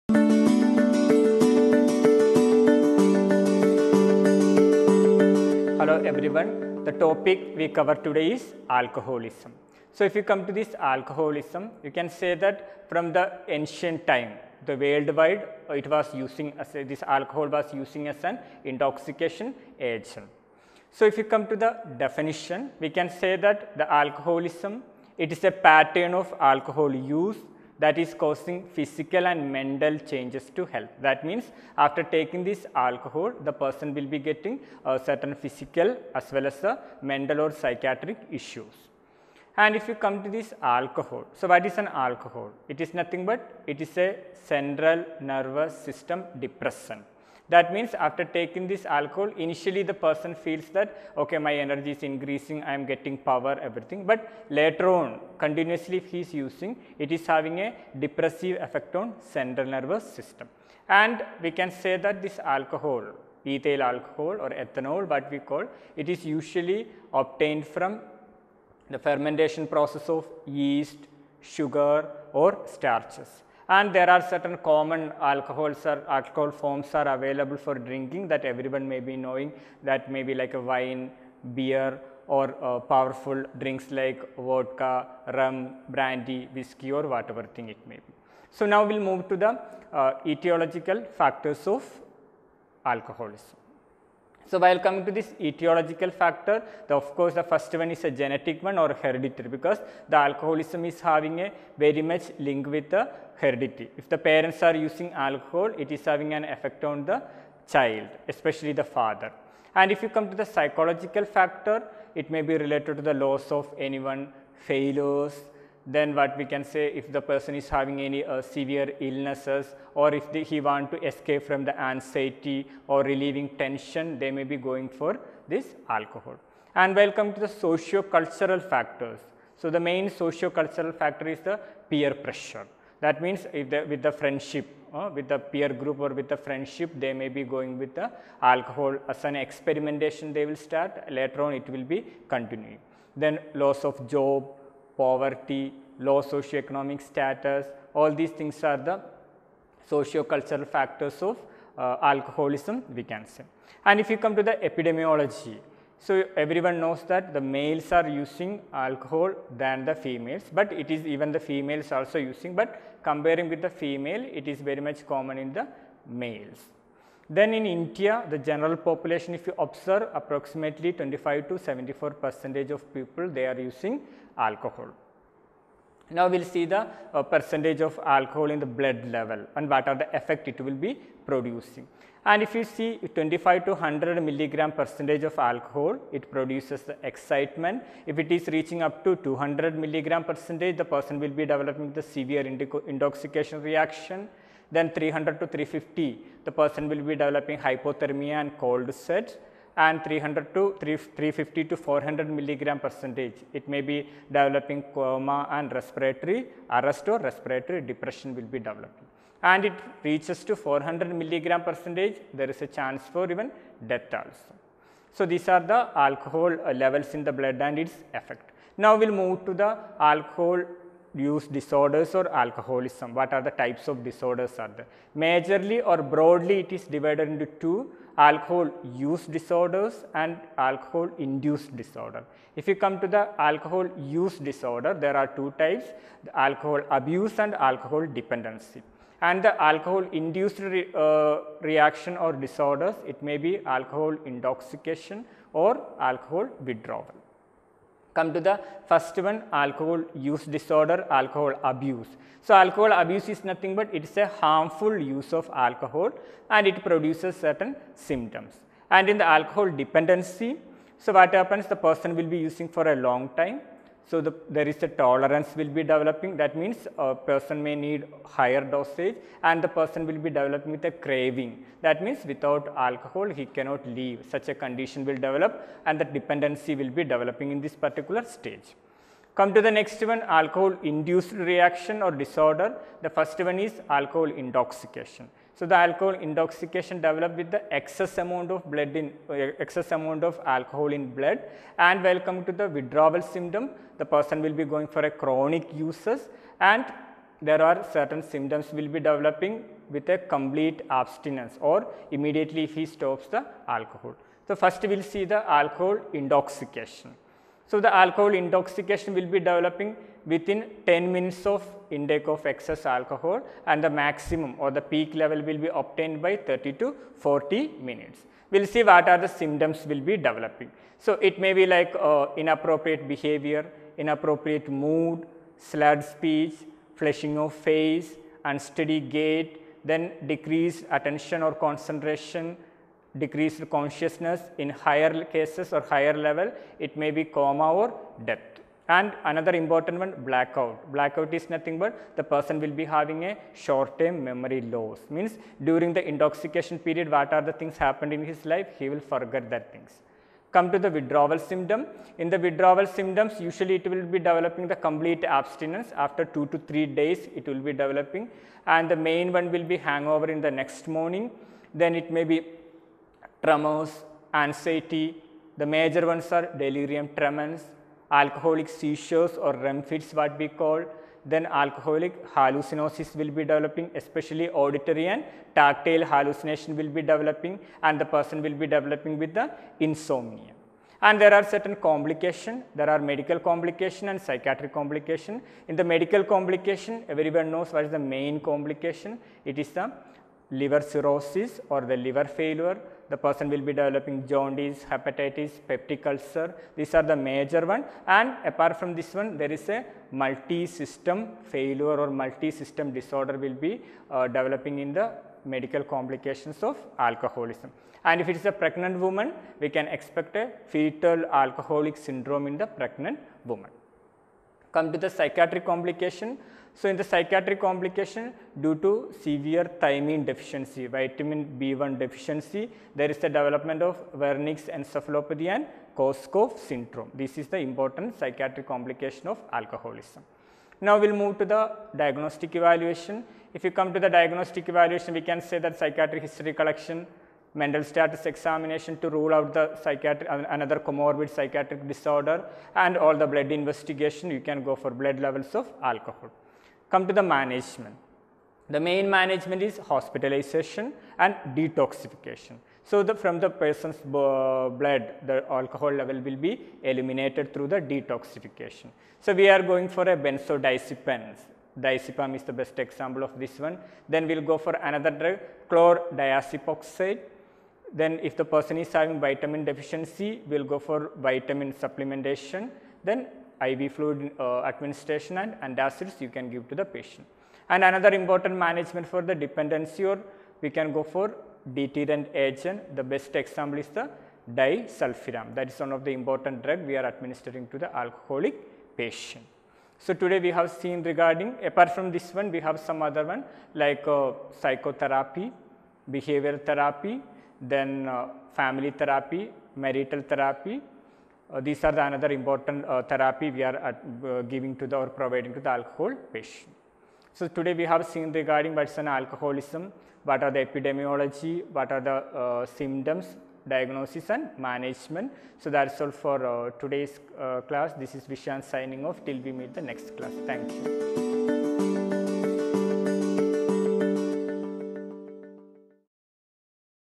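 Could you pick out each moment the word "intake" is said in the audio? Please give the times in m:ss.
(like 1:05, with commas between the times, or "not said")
5:11.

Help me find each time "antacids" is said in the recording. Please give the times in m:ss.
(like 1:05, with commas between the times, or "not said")
7:55.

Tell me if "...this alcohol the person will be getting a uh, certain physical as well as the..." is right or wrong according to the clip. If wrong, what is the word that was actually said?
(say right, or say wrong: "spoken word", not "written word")
right.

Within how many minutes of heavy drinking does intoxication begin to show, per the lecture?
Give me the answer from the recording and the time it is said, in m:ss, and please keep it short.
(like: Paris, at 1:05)
10 minutes, at 5:10.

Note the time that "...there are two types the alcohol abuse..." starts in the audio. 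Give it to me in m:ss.
3:54.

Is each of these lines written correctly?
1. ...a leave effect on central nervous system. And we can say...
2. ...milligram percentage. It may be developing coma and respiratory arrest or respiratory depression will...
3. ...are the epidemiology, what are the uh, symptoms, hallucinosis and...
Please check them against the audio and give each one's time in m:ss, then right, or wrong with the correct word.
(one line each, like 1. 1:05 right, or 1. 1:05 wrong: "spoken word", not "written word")
1. 0:57 wrong: "depressive", not "leave"
2. 3:22 right
3. 8:30 wrong: "diagnosis", not "hallucinosis".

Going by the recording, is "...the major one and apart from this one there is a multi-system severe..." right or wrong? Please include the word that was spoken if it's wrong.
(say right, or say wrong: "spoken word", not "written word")
wrong: "failure", not "severe".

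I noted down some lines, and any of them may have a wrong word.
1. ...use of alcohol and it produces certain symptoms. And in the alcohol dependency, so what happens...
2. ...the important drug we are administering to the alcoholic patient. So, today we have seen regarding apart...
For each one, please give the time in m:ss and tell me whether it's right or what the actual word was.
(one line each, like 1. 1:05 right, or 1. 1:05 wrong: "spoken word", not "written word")
1. 4:14 right
2. 8:06 right.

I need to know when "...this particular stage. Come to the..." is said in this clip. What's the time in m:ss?
4:37.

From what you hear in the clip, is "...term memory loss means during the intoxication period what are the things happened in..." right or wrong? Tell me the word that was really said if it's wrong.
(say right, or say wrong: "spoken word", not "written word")
right.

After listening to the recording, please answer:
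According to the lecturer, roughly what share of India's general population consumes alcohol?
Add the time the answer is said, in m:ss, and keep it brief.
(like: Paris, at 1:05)
25 to 74 percent, at 2:50.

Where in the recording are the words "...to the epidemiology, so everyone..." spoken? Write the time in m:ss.
2:34.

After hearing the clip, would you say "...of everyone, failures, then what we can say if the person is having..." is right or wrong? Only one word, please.
wrong.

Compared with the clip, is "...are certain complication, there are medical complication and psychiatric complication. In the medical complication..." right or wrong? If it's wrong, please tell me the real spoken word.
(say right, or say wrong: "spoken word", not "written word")
right.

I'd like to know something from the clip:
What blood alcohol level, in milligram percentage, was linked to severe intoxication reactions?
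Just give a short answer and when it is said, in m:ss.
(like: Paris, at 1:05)
200, at 3:09.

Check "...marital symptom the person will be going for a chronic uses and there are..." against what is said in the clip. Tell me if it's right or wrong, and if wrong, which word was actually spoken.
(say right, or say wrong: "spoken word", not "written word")
wrong: "withdrawal", not "marital".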